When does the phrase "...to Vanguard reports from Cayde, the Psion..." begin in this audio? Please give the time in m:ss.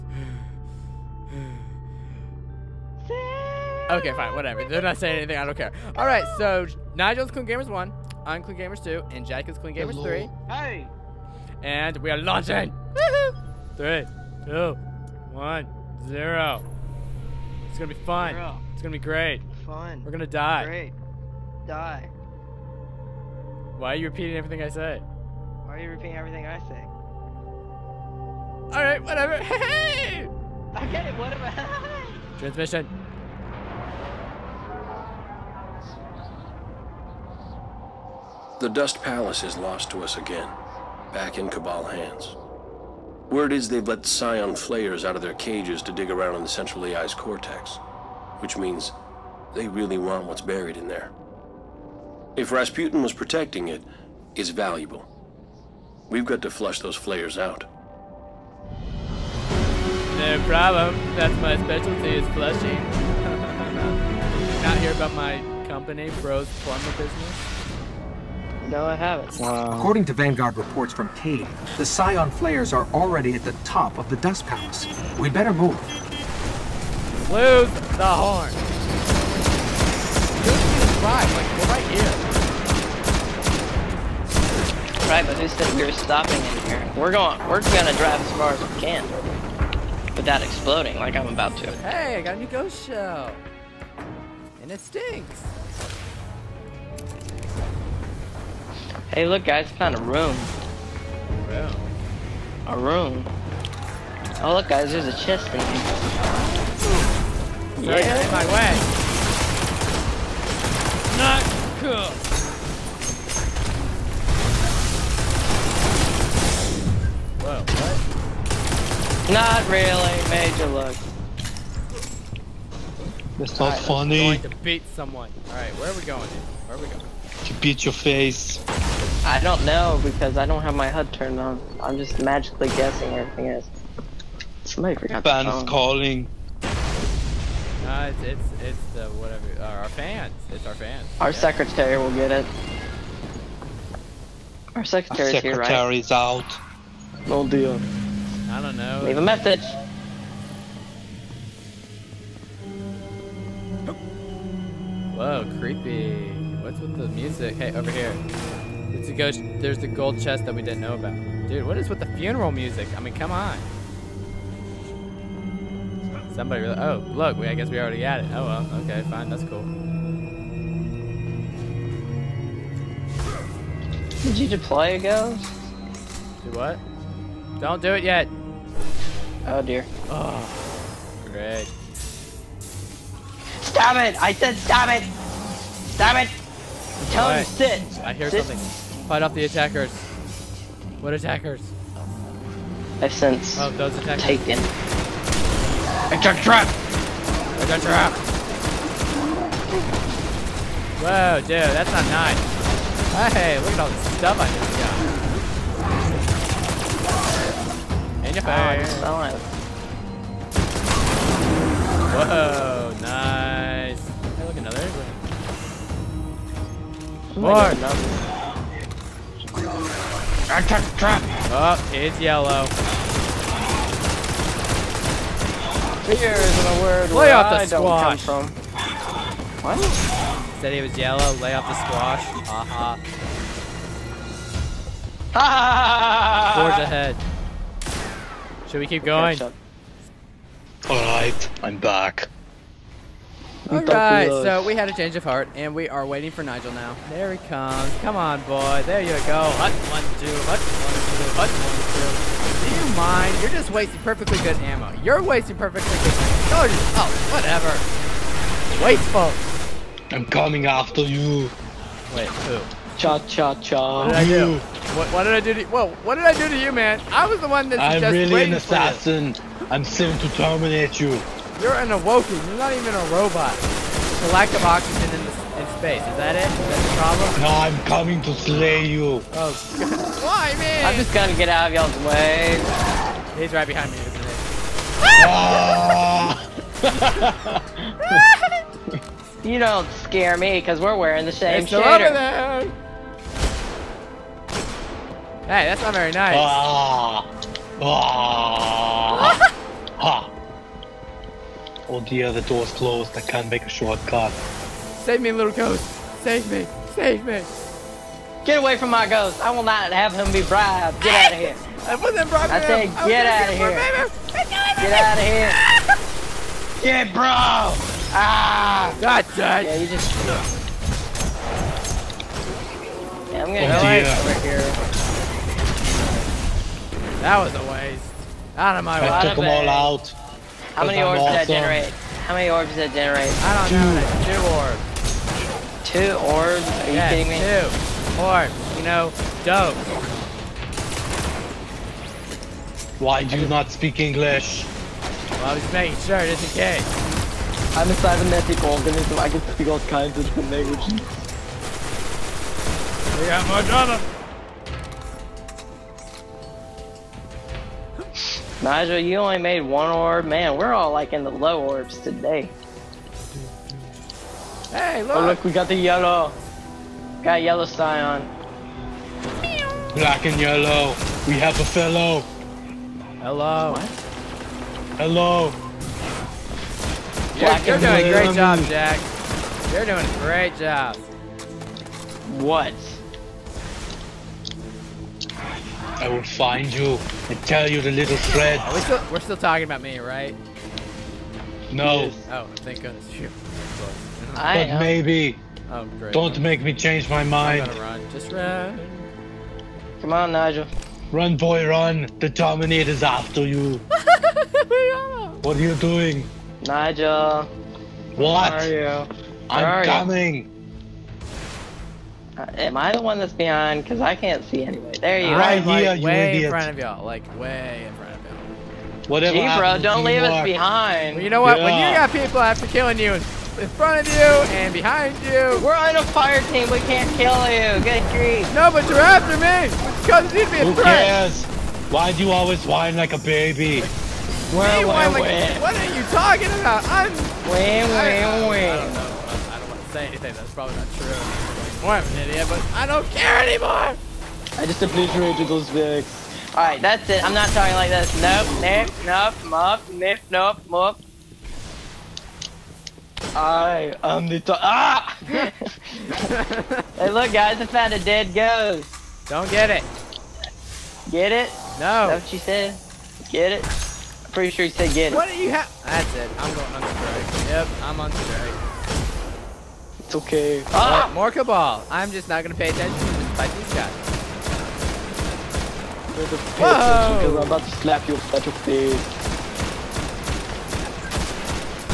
1:10.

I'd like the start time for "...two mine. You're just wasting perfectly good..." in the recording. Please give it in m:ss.
4:11.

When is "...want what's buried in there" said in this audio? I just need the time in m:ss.
0:49.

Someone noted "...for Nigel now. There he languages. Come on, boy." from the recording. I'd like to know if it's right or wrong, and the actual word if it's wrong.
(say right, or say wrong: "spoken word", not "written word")
wrong: "comes", not "languages".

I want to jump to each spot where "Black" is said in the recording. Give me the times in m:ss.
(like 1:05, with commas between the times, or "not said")
6:09.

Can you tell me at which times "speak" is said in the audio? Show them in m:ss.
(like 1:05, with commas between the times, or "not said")
5:43, 5:49.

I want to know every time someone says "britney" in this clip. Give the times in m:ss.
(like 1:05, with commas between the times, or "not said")
not said.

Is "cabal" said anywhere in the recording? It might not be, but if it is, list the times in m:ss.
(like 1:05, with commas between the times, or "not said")
0:41, 7:51.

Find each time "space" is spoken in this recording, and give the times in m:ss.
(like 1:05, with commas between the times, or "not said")
4:35.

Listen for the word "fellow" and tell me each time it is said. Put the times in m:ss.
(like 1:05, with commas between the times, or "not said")
6:11.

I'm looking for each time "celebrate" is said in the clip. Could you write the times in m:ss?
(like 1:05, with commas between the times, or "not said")
not said.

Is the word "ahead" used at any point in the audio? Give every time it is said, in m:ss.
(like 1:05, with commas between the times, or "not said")
3:56.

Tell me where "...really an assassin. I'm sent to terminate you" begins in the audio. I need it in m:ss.
4:28.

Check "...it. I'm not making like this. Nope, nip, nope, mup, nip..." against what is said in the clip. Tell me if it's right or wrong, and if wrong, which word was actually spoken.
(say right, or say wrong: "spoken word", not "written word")
wrong: "talking", not "making".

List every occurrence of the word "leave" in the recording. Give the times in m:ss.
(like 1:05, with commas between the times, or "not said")
2:29, 7:00.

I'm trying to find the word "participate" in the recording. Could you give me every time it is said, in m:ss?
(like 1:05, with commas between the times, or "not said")
not said.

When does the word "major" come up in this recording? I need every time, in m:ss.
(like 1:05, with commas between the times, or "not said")
2:00.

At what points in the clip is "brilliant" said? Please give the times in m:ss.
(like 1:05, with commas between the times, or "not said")
not said.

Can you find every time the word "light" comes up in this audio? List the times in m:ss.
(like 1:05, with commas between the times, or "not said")
not said.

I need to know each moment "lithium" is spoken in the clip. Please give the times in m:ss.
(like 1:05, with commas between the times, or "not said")
not said.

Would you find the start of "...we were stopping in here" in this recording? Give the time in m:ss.
1:25.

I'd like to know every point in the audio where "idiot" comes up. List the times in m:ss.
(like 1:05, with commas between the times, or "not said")
6:56, 7:22.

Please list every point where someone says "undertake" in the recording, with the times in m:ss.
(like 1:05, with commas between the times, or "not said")
not said.